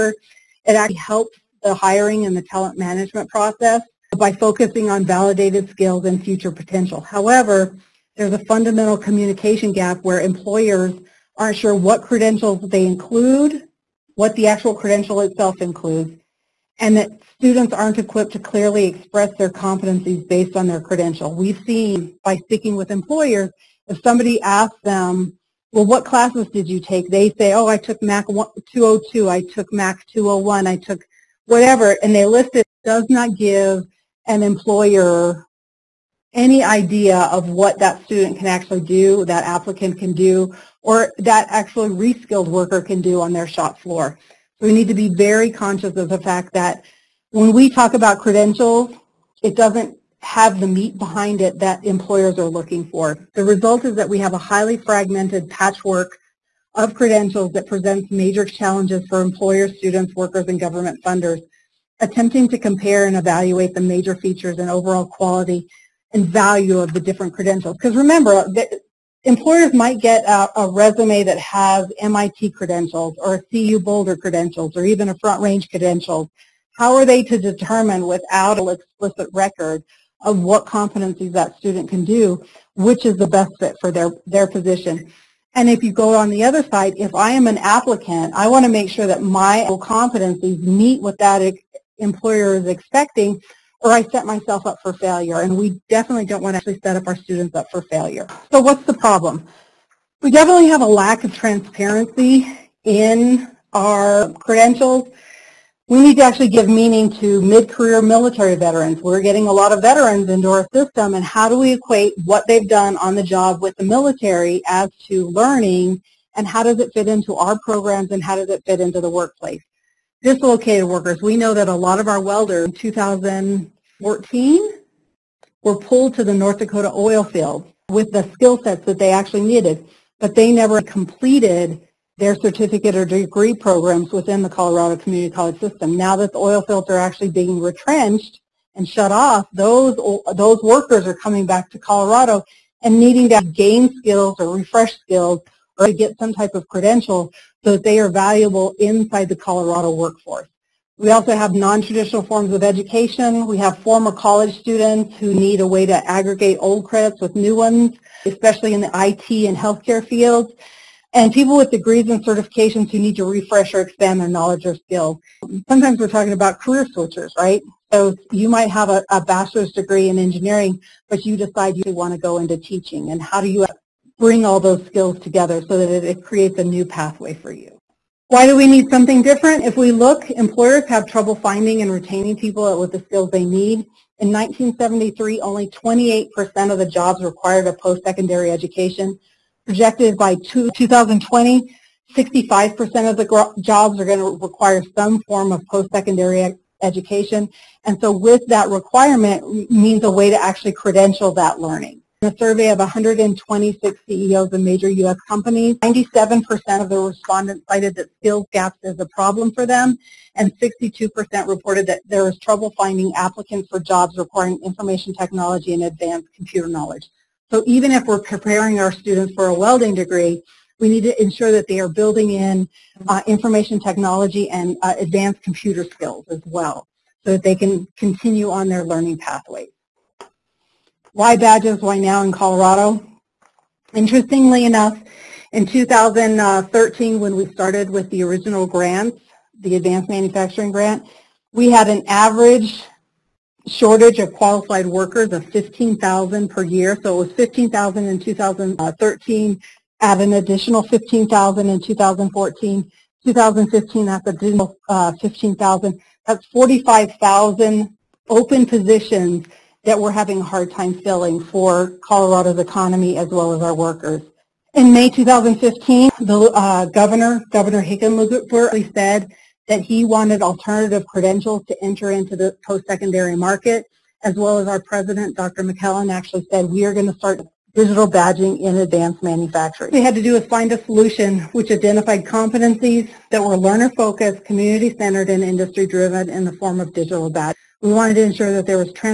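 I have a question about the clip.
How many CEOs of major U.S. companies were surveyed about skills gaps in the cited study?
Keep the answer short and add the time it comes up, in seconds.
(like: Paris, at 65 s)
126, at 202 s.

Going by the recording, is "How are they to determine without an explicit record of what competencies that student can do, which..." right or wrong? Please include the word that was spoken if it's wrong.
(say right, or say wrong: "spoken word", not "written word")
right.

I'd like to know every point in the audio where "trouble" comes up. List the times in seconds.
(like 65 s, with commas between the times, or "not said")
181 s, 212 s.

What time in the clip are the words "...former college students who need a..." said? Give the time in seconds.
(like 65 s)
153 s.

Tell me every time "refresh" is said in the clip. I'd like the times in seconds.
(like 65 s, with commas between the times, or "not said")
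144 s, 163 s.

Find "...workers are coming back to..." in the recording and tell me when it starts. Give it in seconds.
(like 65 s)
140 s.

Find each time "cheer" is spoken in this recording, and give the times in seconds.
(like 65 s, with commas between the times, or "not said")
not said.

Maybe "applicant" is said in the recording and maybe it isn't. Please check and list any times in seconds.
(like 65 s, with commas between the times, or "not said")
39 s, 87 s, 213 s.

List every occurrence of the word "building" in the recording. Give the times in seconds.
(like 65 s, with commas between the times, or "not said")
221 s.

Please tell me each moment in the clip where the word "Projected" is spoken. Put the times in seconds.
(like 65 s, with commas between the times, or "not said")
189 s.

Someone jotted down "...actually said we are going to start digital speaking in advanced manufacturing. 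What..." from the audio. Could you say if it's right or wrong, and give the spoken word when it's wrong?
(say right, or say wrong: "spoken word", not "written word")
wrong: "badging", not "speaking".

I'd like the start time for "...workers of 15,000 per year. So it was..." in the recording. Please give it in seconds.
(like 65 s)
244 s.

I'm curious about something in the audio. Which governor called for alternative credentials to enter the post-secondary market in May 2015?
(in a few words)
Governor Hickenlooper.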